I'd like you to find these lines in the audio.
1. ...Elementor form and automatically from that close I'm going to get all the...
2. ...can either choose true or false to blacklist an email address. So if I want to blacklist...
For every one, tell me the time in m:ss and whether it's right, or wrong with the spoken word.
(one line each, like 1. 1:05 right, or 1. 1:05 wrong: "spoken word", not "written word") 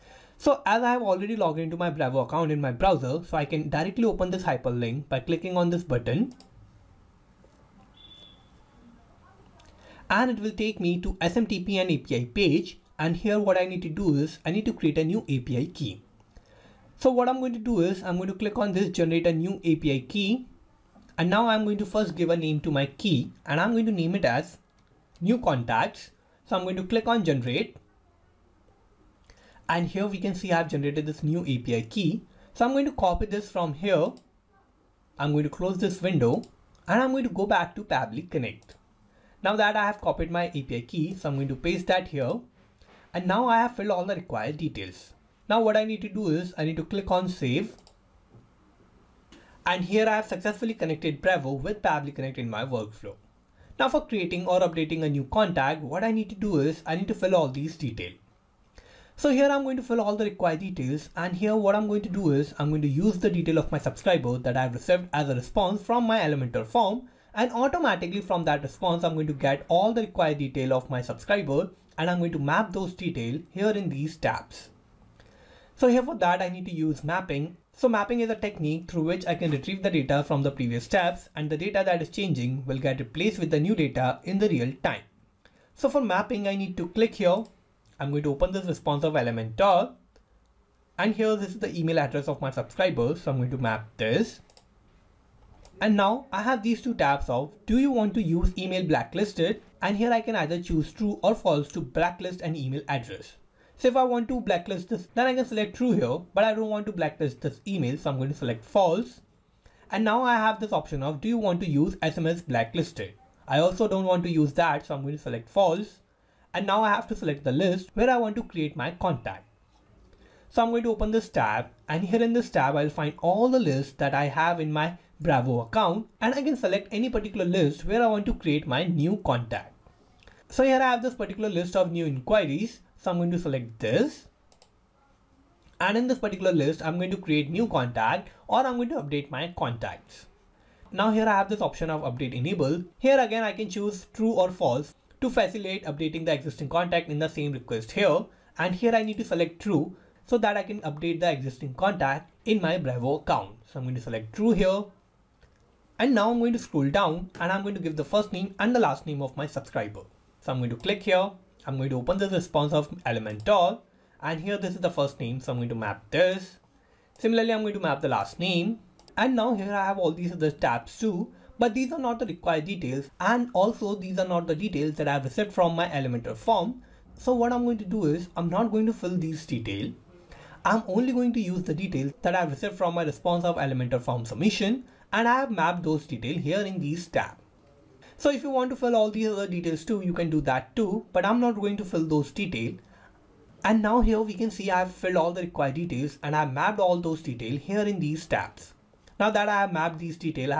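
1. 1:06 wrong: "response", not "close"
2. 1:40 right.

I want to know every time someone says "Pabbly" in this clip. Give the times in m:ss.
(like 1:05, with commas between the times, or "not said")
0:37, 0:51.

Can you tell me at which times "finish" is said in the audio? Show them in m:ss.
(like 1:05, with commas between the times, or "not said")
not said.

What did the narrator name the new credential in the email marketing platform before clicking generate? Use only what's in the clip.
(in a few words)
new contacts.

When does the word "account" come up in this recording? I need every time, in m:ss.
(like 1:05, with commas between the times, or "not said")
0:02, 2:05, 2:33.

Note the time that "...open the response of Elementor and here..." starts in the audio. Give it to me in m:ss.
2:41.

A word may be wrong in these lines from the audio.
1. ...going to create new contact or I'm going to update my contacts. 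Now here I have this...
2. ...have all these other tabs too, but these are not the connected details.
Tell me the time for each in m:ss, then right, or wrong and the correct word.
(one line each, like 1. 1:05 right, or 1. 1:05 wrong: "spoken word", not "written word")
1. 2:16 right
2. 2:49 wrong: "required", not "connected".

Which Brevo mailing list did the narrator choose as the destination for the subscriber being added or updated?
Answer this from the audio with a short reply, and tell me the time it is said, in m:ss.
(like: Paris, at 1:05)
new inquiries, at 2:11.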